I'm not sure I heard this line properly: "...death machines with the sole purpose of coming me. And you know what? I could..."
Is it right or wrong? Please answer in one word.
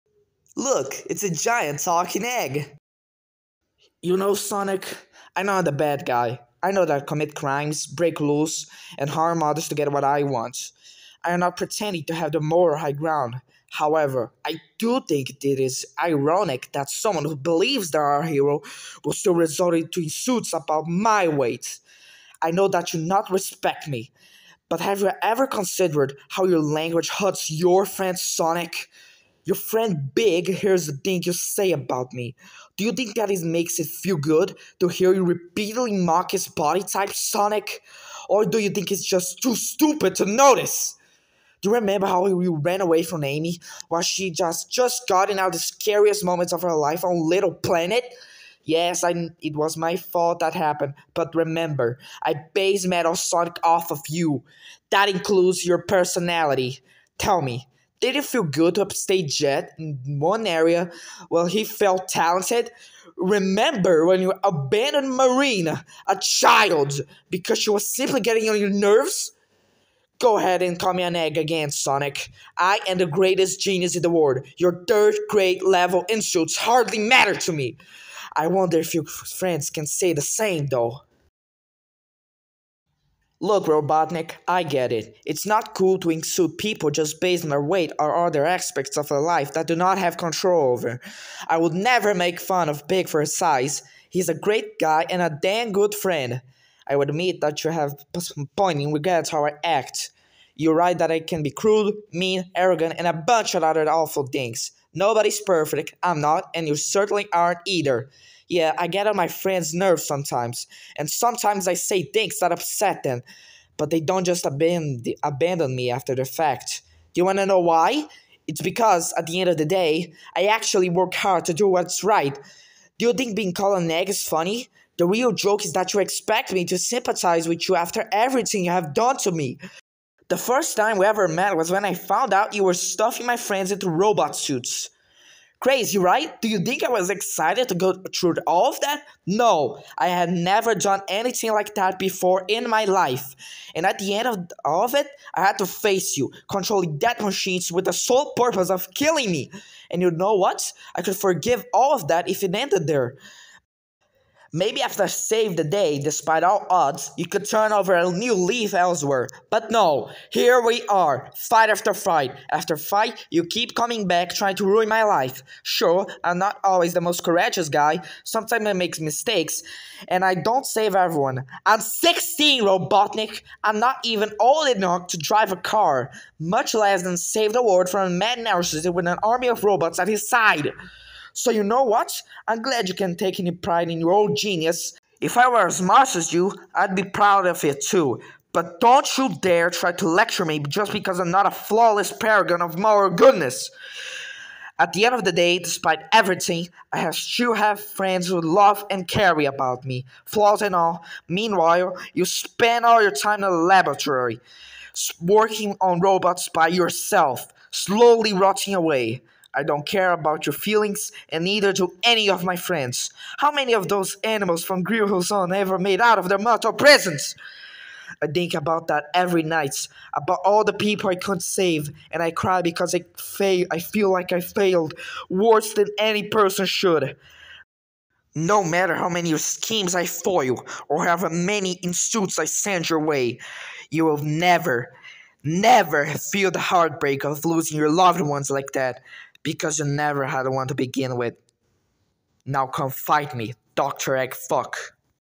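wrong.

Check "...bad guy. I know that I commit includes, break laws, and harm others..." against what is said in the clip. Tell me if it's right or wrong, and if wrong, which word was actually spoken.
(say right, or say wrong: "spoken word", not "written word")
wrong: "crimes", not "includes".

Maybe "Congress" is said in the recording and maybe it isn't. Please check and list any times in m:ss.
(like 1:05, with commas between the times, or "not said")
not said.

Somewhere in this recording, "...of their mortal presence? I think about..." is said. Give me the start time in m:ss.
3:36.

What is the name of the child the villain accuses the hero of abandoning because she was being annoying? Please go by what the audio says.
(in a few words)
Marina.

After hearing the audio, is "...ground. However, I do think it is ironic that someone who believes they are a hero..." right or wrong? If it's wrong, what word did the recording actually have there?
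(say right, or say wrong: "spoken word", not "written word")
right.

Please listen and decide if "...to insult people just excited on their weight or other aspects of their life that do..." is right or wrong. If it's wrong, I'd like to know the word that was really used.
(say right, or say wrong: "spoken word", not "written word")
wrong: "based", not "excited".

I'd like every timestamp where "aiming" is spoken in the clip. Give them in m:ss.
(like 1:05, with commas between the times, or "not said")
not said.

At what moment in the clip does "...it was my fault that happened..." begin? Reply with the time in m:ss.
0:49.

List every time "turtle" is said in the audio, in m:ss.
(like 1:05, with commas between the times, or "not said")
not said.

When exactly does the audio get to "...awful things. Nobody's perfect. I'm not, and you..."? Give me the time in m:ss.
1:43.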